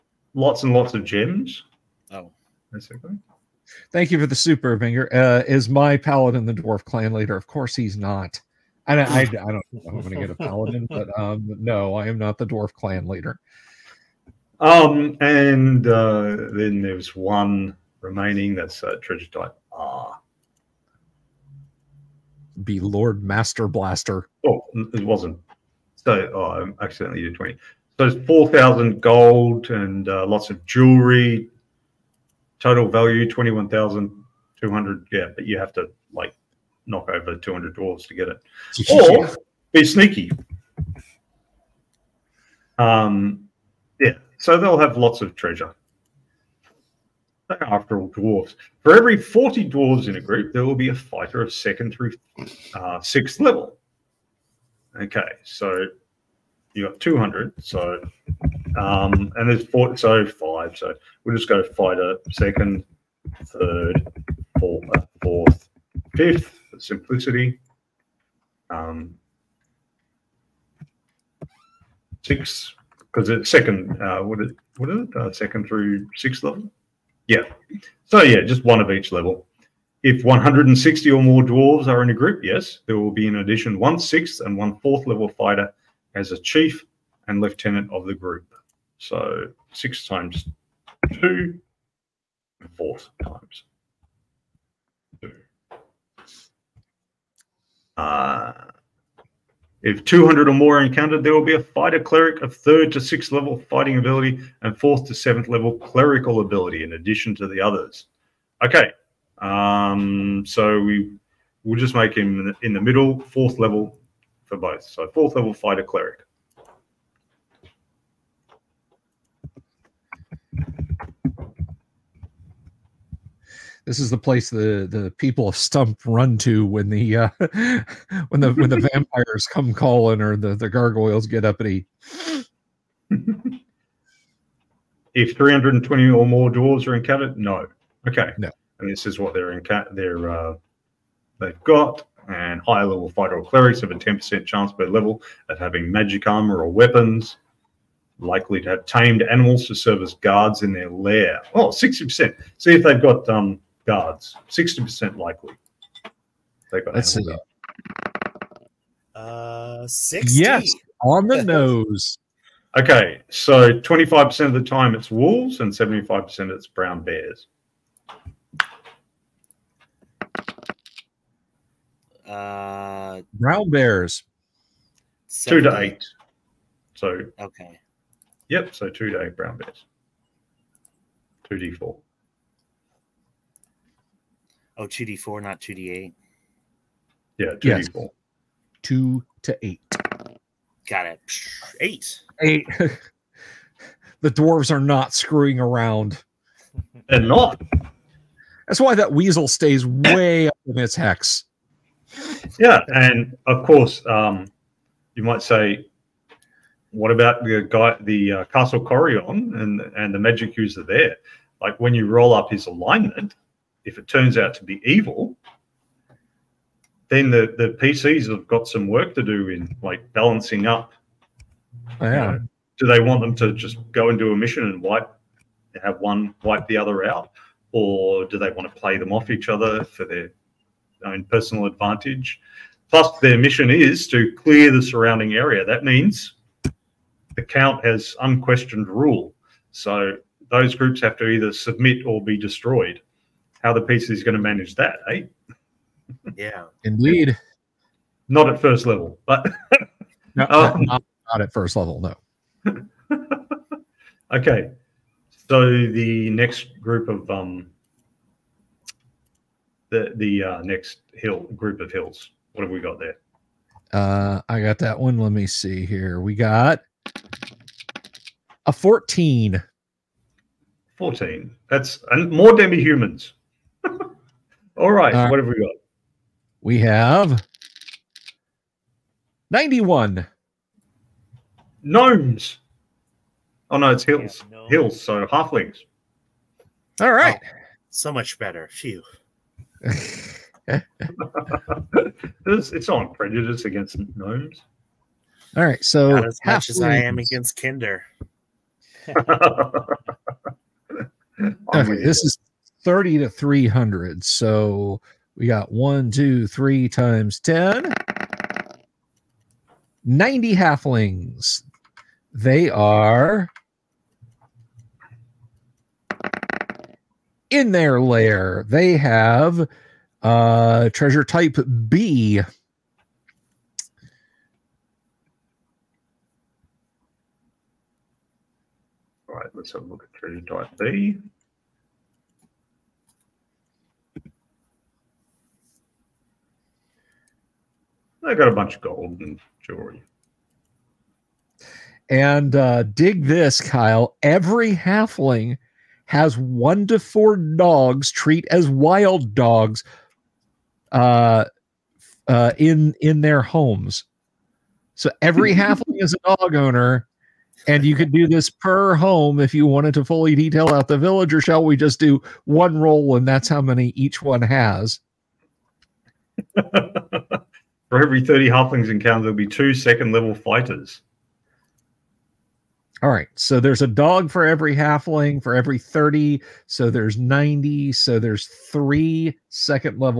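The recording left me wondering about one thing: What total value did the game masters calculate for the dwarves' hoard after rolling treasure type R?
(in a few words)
21,200.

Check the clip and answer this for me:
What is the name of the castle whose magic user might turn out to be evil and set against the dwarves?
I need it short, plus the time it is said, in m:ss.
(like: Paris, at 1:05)
Castle Corion, at 3:28.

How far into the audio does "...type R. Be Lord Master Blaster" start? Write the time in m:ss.
0:19.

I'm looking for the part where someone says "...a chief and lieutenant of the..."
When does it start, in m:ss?
1:26.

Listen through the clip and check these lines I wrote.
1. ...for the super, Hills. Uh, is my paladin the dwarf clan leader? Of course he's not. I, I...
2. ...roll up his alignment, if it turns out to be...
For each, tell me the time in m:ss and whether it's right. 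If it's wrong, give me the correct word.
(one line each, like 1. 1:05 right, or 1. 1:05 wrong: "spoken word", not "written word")
1. 0:04 wrong: "Binger", not "Hills"
2. 3:32 right.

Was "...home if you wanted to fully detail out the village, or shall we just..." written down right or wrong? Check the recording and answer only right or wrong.
right.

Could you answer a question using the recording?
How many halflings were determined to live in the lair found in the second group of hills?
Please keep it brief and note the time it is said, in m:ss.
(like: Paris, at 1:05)
90, at 5:10.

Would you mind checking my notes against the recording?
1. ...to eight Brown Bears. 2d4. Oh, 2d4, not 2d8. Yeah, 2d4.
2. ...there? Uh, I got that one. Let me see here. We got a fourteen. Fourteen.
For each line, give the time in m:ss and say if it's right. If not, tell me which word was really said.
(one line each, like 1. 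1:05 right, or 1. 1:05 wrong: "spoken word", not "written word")
1. 2:59 right
2. 4:22 right.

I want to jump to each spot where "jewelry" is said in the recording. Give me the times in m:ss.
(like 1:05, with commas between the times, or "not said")
0:30, 5:39.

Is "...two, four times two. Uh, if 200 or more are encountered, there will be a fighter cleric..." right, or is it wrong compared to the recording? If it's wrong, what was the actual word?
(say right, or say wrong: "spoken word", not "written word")
right.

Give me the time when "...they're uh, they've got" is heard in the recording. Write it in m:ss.
2:19.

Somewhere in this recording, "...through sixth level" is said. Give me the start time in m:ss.
1:15.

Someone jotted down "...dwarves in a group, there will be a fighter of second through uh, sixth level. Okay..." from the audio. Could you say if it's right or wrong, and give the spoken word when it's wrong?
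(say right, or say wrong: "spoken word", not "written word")
right.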